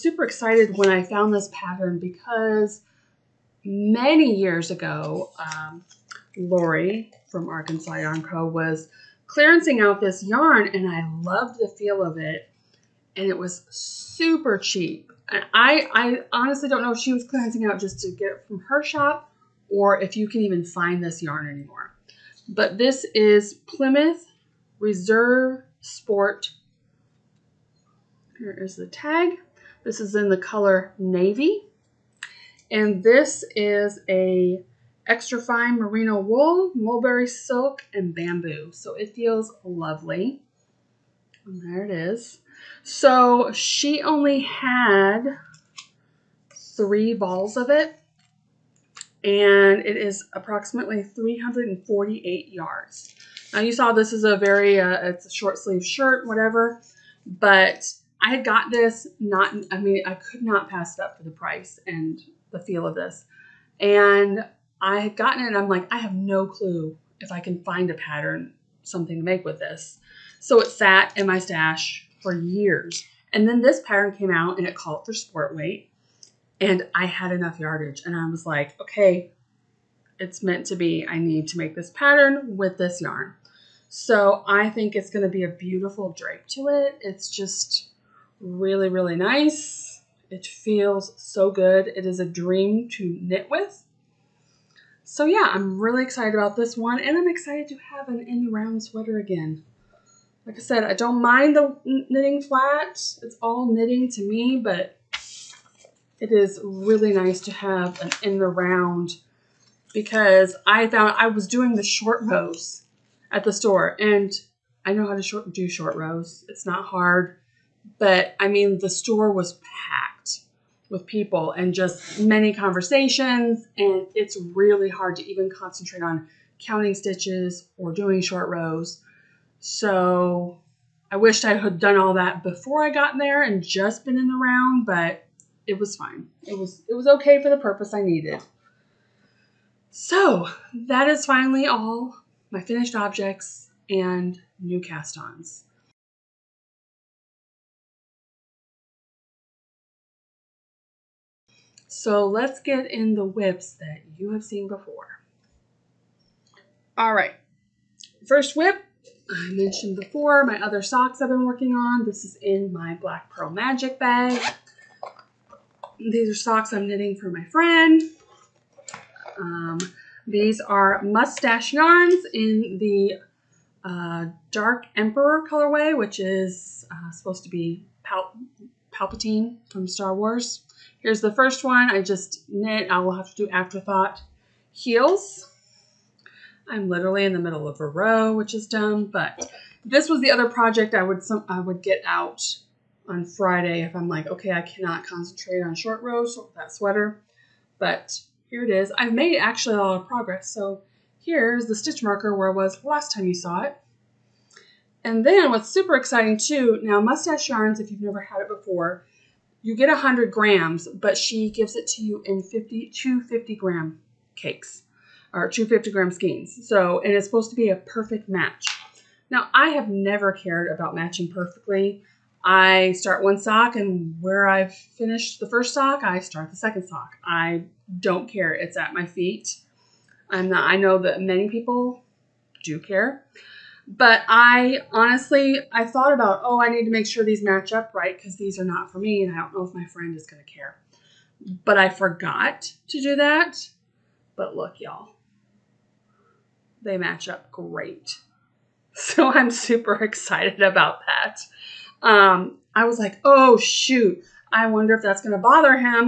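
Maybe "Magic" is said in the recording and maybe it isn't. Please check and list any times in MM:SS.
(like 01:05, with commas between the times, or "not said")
02:43.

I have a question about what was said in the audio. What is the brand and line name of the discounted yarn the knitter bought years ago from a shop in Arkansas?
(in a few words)
Plymouth Reserve Sport.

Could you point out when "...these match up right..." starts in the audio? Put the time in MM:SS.
03:57.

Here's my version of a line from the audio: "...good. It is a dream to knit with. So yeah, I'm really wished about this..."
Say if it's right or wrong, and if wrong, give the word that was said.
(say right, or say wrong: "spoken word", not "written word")
wrong: "excited", not "wished".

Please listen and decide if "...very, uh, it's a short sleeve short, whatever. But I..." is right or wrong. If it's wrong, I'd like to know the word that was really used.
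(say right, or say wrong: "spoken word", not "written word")
wrong: "shirt", not "short".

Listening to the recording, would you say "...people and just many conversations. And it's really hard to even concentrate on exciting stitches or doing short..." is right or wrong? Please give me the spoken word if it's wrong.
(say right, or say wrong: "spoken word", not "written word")
wrong: "counting", not "exciting".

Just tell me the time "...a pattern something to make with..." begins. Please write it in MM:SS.
01:07.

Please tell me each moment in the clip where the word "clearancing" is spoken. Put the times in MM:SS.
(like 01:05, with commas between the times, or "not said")
00:09, 00:17.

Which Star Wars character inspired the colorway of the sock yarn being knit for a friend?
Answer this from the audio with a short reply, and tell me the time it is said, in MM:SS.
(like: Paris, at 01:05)
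Palpatine, at 02:58.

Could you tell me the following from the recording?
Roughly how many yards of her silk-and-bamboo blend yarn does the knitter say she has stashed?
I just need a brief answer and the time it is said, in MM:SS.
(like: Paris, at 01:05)
348, at 00:51.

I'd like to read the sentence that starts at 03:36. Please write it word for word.
So, and it's supposed to be a perfect match.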